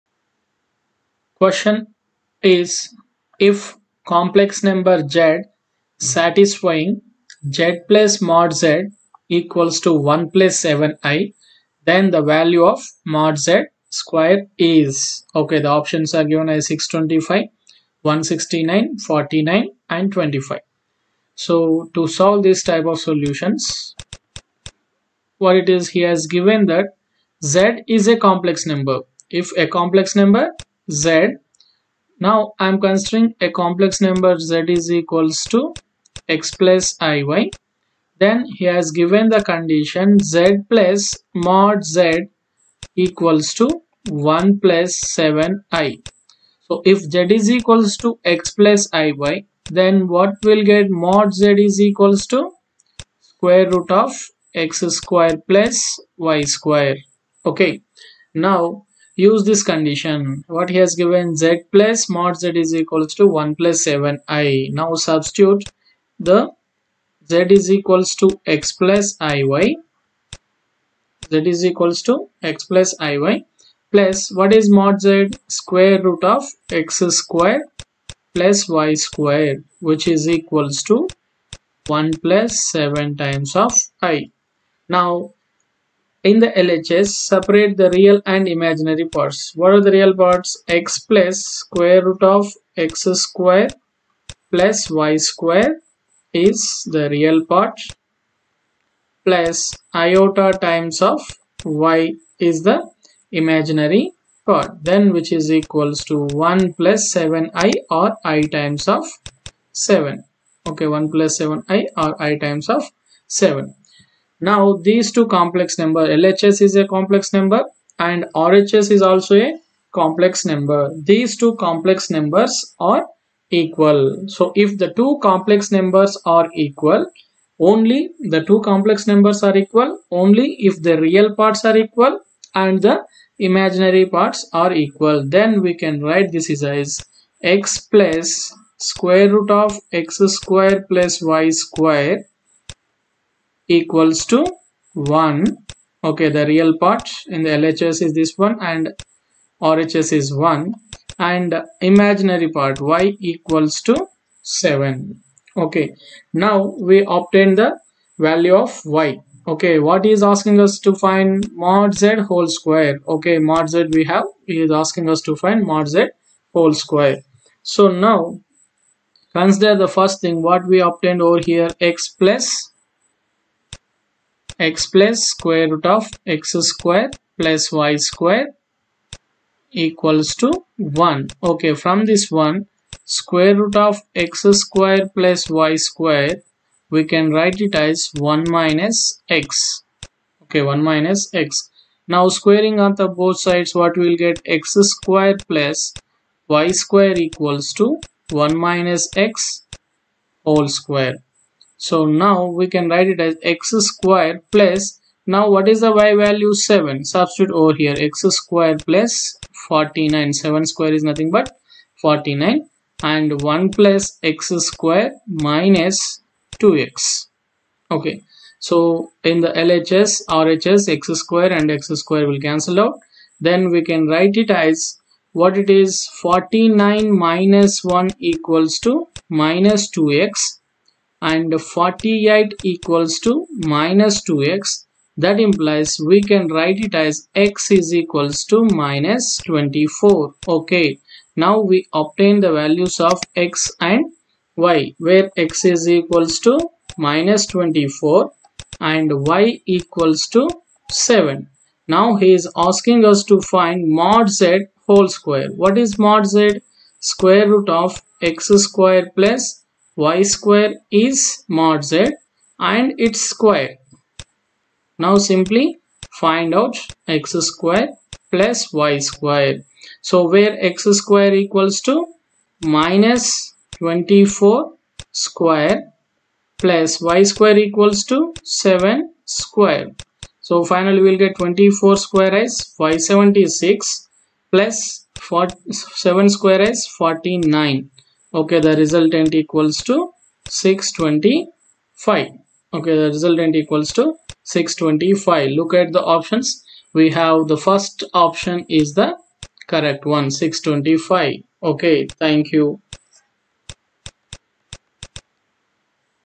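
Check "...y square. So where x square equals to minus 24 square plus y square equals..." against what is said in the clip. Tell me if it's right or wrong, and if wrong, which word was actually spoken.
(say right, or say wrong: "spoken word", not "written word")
right.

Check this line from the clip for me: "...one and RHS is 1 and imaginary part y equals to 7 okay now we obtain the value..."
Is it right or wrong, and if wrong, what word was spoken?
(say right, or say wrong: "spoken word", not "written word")
right.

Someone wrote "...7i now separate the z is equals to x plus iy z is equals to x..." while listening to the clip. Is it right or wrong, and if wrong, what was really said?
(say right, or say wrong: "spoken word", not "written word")
wrong: "substitute", not "separate".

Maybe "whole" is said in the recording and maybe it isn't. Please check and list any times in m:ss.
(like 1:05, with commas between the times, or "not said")
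2:42, 2:46, 3:20, 4:14.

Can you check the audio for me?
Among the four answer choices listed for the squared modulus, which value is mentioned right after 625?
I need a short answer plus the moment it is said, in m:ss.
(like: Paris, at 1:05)
169, at 0:17.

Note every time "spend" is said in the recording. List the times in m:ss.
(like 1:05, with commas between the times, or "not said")
not said.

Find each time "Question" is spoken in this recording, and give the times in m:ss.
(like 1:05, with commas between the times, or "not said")
0:01.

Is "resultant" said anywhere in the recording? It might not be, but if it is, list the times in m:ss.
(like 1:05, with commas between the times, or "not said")
4:48, 4:53.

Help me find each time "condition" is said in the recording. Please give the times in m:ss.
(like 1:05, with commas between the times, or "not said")
0:39, 0:59.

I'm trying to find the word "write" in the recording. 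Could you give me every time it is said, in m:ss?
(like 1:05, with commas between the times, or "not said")
2:16, 3:07, 3:22, 3:44, 3:56.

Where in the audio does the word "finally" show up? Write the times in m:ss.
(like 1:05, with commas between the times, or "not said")
4:40.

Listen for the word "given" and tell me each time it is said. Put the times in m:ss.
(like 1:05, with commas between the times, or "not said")
0:16, 0:26, 0:38, 1:00.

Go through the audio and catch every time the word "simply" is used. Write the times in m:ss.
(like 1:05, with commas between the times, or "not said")
4:25.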